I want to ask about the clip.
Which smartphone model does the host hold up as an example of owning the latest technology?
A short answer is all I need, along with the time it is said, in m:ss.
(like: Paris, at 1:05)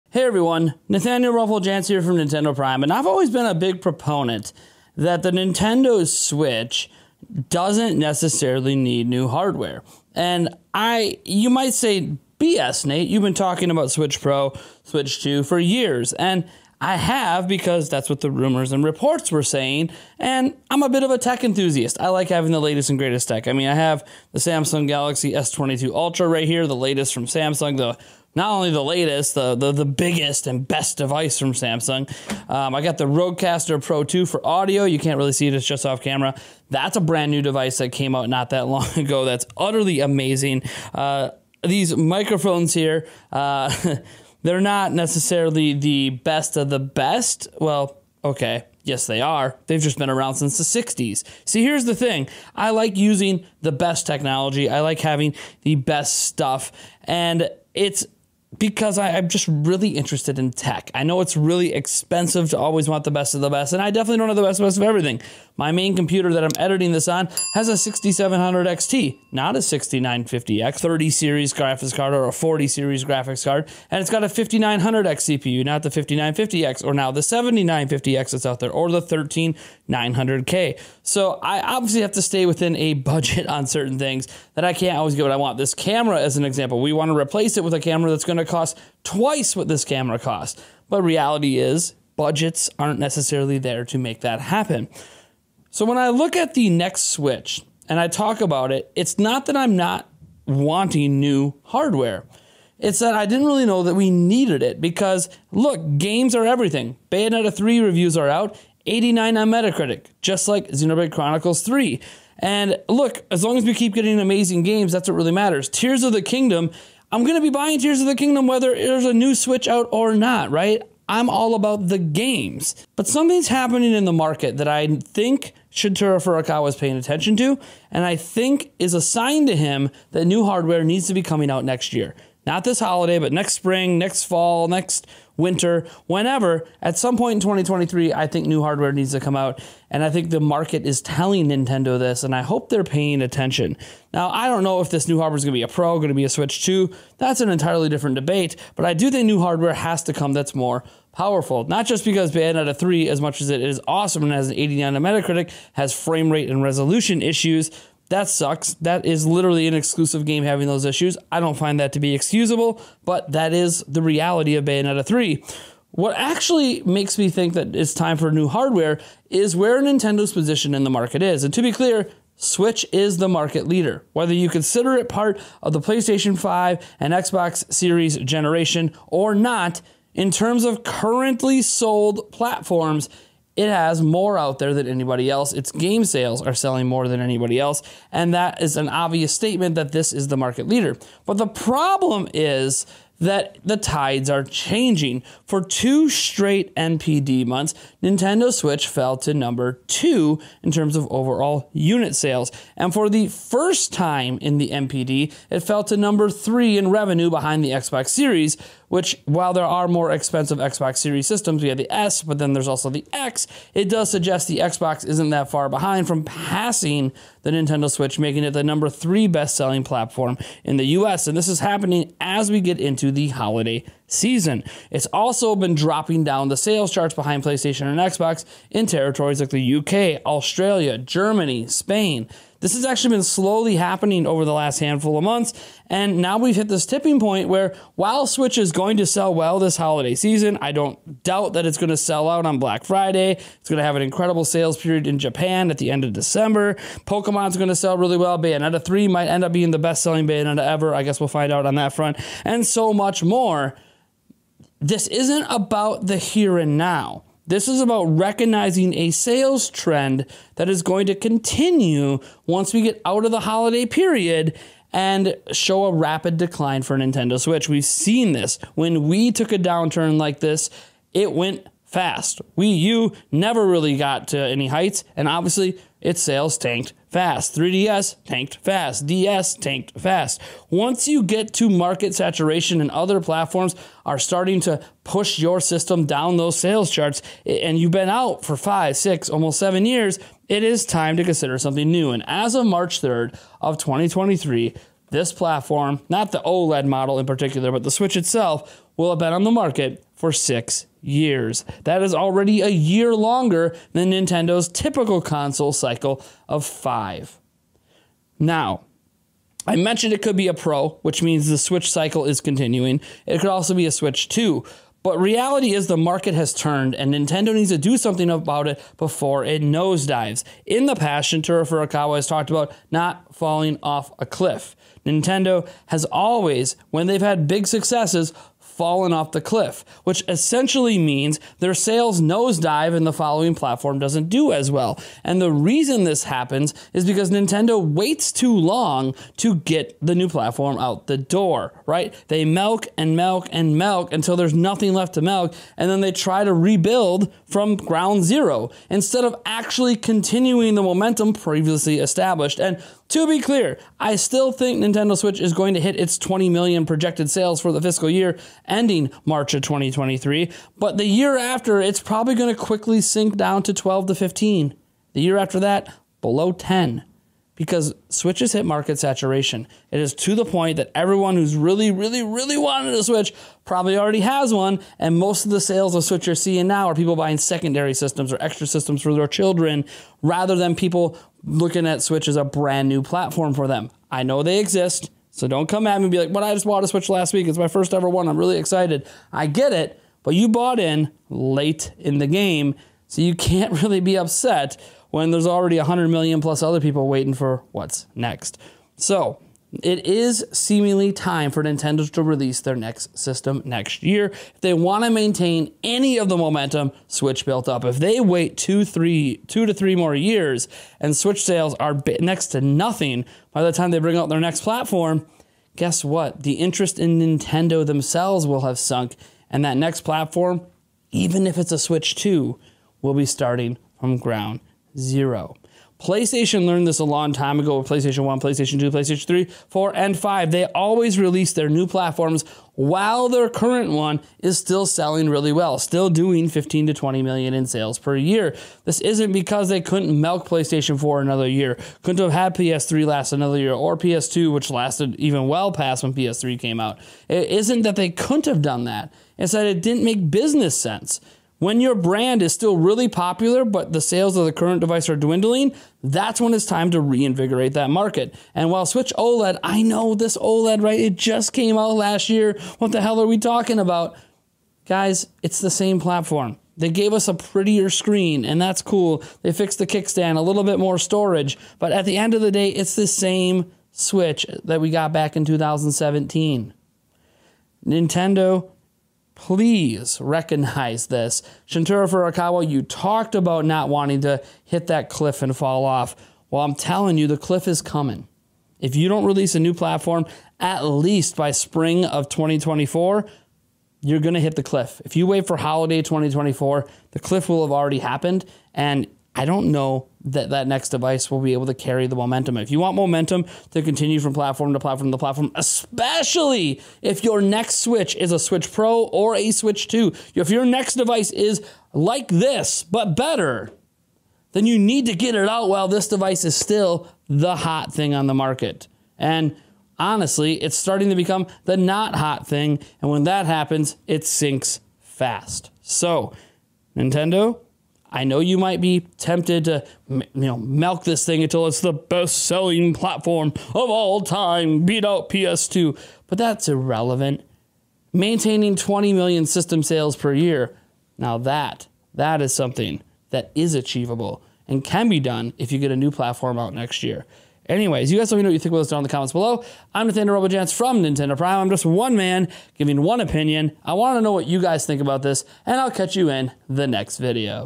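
Samsung Galaxy S22 Ultra, at 0:24.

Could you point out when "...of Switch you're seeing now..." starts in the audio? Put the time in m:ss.
6:15.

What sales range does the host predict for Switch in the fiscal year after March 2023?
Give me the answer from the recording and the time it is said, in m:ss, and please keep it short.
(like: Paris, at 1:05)
12 to 15, at 6:03.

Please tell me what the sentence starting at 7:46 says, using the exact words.
They gave us a prettier screen, and that's cool.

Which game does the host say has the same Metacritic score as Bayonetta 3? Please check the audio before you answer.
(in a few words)
Xenoblade Chronicles 3.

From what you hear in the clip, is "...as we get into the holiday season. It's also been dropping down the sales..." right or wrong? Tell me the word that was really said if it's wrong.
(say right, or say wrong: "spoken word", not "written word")
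right.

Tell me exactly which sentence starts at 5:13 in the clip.
It could also be a Switch 2.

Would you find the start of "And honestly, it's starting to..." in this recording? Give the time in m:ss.
8:39.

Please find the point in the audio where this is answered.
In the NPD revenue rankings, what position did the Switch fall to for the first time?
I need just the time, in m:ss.
3:25.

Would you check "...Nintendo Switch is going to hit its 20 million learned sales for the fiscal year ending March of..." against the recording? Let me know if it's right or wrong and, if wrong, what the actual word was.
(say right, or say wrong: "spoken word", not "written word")
wrong: "projected", not "learned".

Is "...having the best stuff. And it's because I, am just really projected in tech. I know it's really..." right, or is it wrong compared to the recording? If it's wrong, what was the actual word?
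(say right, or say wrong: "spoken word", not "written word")
wrong: "interested", not "projected".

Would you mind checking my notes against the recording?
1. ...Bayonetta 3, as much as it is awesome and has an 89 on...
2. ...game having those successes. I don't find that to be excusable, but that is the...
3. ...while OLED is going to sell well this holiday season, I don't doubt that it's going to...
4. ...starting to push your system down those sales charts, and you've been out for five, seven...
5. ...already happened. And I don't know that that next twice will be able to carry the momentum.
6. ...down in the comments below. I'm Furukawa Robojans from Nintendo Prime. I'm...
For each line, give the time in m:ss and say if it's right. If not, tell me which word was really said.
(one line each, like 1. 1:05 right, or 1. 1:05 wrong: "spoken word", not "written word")
1. 2:32 right
2. 2:40 wrong: "issues", not "successes"
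3. 3:57 wrong: "Switch", not "OLED"
4. 4:44 wrong: "six", not "seven"
5. 8:17 wrong: "device", not "twice"
6. 9:08 wrong: "Nathaniel", not "Furukawa".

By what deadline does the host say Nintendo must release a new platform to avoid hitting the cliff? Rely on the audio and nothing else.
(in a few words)
Spring of 2024.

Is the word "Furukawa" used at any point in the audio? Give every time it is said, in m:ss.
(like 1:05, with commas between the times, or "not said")
2:06, 5:21, 8:02.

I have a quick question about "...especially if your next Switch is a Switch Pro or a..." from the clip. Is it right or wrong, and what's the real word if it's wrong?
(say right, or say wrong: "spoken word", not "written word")
right.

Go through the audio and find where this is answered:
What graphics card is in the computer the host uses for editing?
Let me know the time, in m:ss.
1:07.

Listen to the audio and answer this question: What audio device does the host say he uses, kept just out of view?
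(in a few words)
Rodecaster Pro 2.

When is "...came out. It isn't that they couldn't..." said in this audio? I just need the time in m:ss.
7:26.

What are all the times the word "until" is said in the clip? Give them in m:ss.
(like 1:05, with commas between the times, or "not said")
5:44, 8:51.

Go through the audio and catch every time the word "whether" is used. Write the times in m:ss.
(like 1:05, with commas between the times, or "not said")
1:58, 2:54.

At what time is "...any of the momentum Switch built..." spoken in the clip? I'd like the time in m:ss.
6:45.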